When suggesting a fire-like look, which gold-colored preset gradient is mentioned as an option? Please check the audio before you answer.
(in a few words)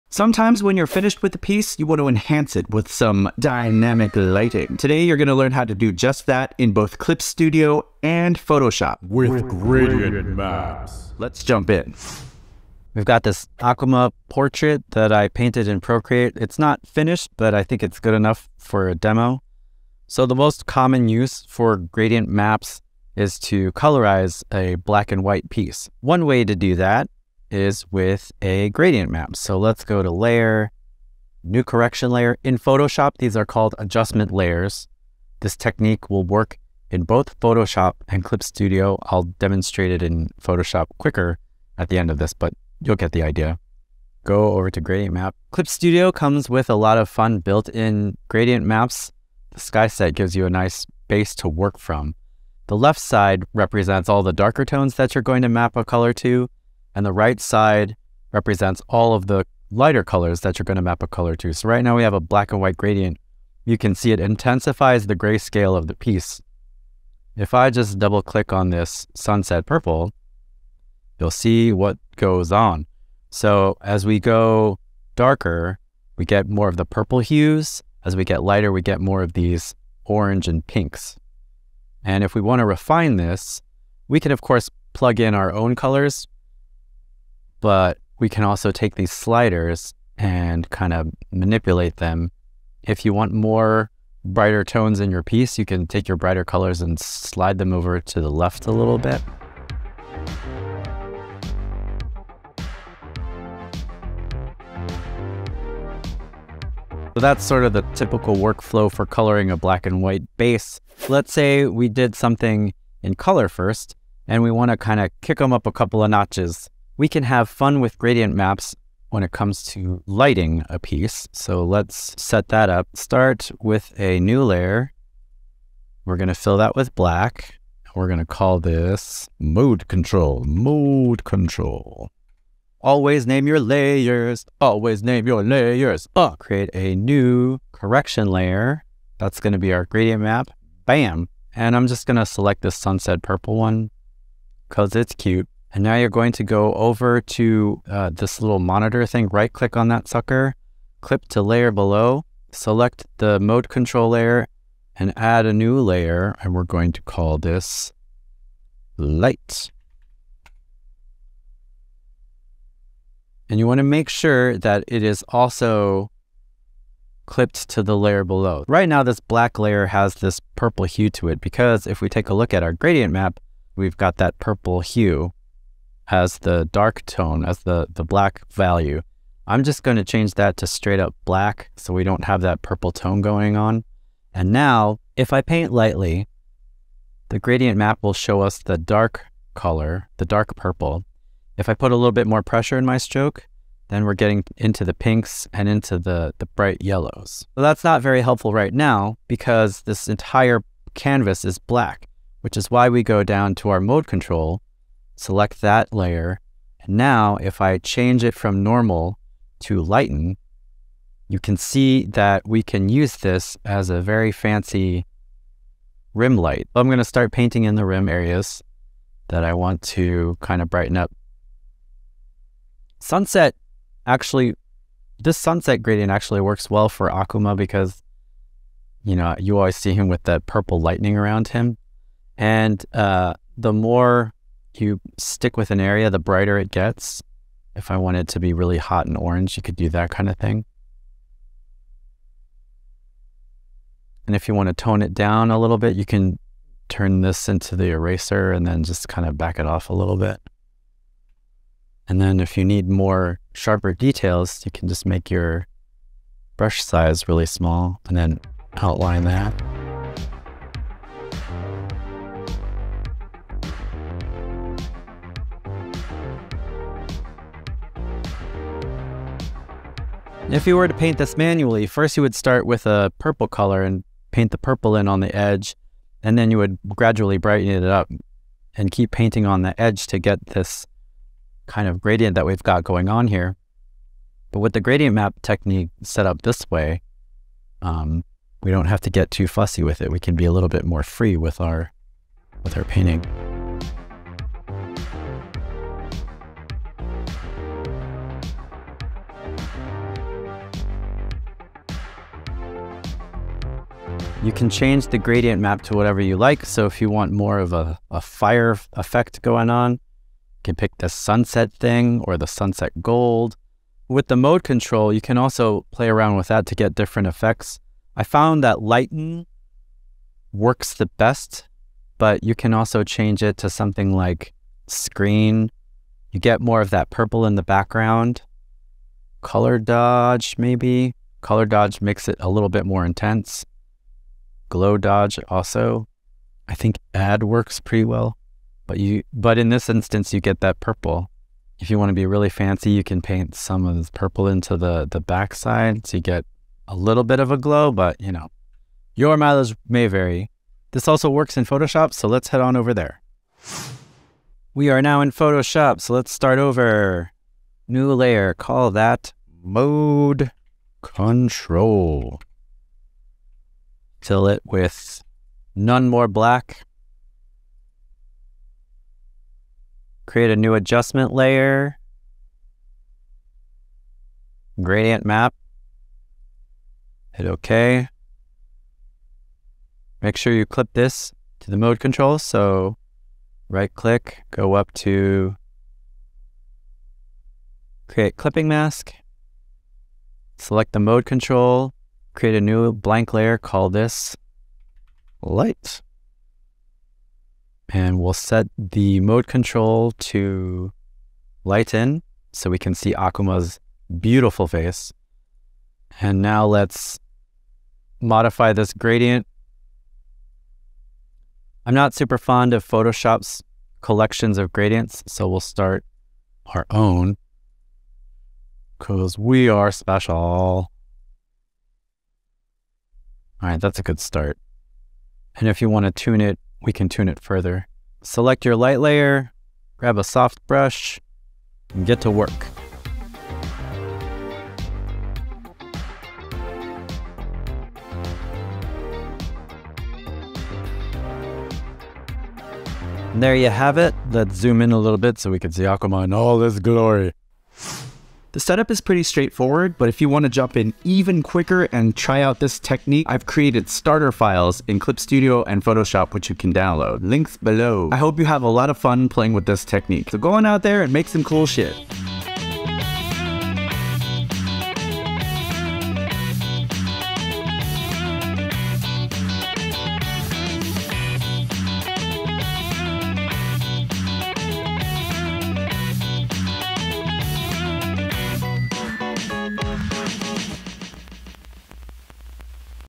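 Sunset gold.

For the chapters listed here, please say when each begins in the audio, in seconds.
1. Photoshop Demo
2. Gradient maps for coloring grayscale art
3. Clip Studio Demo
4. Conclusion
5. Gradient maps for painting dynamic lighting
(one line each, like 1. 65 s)
1. 353 s
2. 45 s
3. 12 s
4. 448 s
5. 111 s.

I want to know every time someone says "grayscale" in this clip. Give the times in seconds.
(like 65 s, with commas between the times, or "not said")
65 s.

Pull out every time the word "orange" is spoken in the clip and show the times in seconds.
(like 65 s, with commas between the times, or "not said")
80 s, 239 s.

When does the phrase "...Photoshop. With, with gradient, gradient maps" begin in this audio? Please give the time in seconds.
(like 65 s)
8 s.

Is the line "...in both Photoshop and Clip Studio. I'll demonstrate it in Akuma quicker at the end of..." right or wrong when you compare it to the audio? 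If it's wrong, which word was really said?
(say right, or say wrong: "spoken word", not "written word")
wrong: "Photoshop", not "Akuma".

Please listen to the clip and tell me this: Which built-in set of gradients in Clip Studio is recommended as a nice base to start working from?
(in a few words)
Sky set.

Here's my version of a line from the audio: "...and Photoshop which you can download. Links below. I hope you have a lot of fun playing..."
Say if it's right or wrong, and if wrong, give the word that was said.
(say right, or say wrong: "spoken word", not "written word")
right.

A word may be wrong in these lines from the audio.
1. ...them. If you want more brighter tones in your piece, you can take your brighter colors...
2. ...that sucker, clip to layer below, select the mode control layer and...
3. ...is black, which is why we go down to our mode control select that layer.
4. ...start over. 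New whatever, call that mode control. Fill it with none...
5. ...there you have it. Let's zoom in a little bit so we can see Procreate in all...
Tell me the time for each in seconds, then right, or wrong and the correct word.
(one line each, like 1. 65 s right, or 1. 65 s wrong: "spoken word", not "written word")
1. 91 s right
2. 149 s right
3. 201 s right
4. 356 s wrong: "layer", not "whatever"
5. 443 s wrong: "Akuma", not "Procreate".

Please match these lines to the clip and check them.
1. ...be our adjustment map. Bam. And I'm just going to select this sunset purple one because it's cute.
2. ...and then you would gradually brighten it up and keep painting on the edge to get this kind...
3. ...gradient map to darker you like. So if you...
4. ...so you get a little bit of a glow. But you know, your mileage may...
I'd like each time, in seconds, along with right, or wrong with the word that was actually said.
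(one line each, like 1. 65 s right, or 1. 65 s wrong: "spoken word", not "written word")
1. 139 s wrong: "gradient", not "adjustment"
2. 276 s right
3. 305 s wrong: "whatever", not "darker"
4. 346 s right.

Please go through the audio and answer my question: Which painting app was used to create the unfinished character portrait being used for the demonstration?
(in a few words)
Procreate.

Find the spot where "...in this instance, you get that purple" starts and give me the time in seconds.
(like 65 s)
339 s.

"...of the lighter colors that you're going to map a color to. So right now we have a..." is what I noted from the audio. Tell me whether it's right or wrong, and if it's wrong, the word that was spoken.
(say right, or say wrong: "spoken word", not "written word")
right.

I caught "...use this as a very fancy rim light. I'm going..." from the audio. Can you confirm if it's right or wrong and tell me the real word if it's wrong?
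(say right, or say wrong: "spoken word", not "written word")
right.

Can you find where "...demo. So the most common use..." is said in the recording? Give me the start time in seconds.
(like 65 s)
18 s.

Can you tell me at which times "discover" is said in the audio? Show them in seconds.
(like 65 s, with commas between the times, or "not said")
not said.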